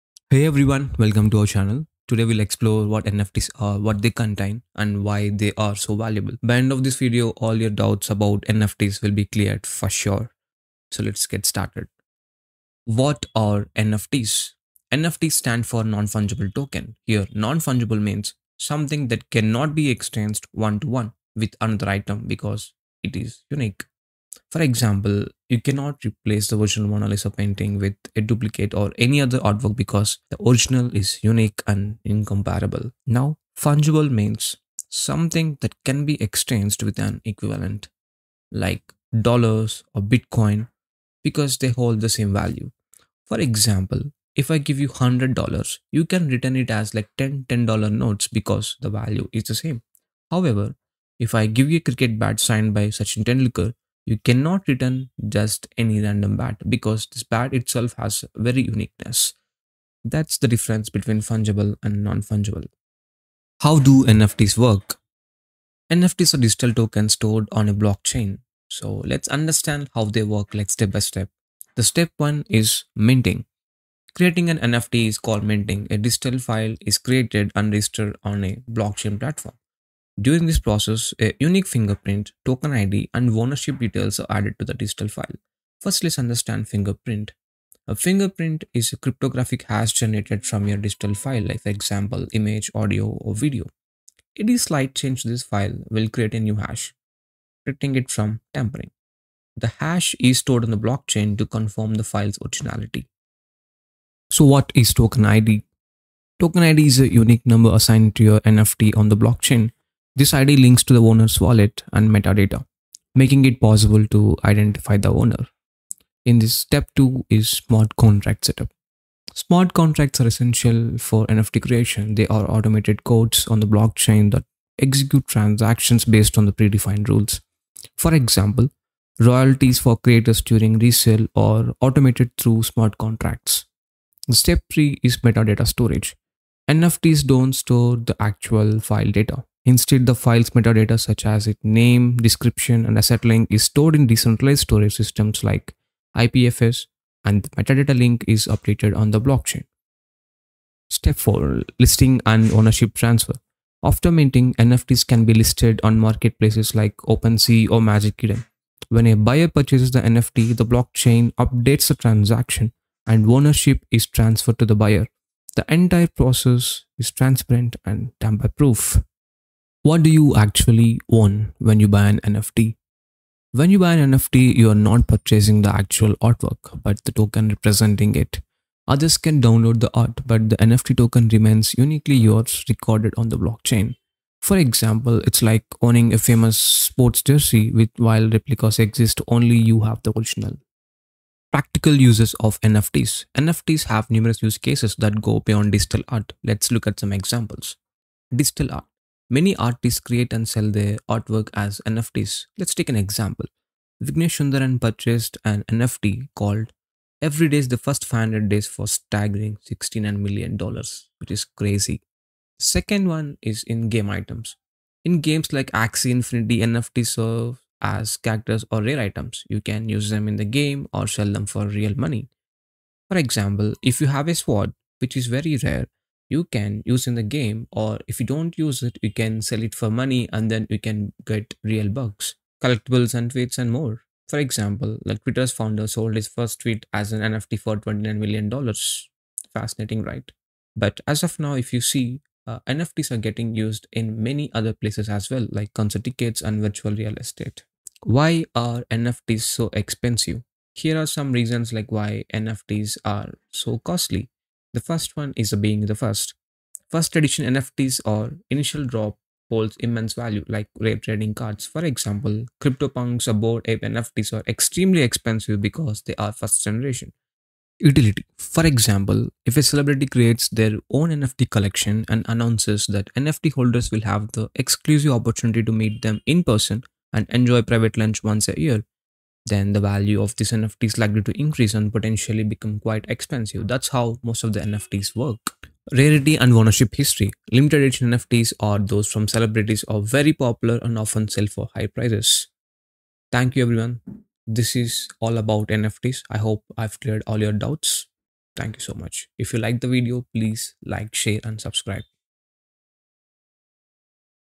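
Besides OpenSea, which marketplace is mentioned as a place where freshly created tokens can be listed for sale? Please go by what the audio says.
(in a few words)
Magic Eden.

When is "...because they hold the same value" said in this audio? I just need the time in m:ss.
0:41.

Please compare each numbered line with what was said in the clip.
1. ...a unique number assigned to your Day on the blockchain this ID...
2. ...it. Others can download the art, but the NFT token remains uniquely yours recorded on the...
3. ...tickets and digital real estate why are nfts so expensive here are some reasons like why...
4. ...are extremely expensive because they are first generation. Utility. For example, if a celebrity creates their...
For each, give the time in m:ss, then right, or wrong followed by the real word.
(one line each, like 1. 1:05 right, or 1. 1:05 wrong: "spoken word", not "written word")
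1. 1:46 wrong: "NFT", not "Day"
2. 2:58 right
3. 4:06 wrong: "virtual", not "digital"
4. 4:24 right.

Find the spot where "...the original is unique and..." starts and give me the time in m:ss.
0:30.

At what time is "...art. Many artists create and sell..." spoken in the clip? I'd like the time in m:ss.
3:18.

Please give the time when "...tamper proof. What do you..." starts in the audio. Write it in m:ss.
2:48.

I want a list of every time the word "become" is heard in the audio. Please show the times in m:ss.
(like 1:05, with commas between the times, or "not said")
4:42.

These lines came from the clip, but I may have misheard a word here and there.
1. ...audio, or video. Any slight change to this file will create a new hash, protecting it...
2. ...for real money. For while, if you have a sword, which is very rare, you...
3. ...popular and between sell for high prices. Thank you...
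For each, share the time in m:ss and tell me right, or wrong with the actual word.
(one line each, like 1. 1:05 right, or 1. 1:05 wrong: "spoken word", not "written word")
1. 1:32 right
2. 3:41 wrong: "example", not "while"
3. 4:50 wrong: "often", not "between".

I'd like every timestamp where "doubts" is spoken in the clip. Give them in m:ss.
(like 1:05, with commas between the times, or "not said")
0:07, 4:57.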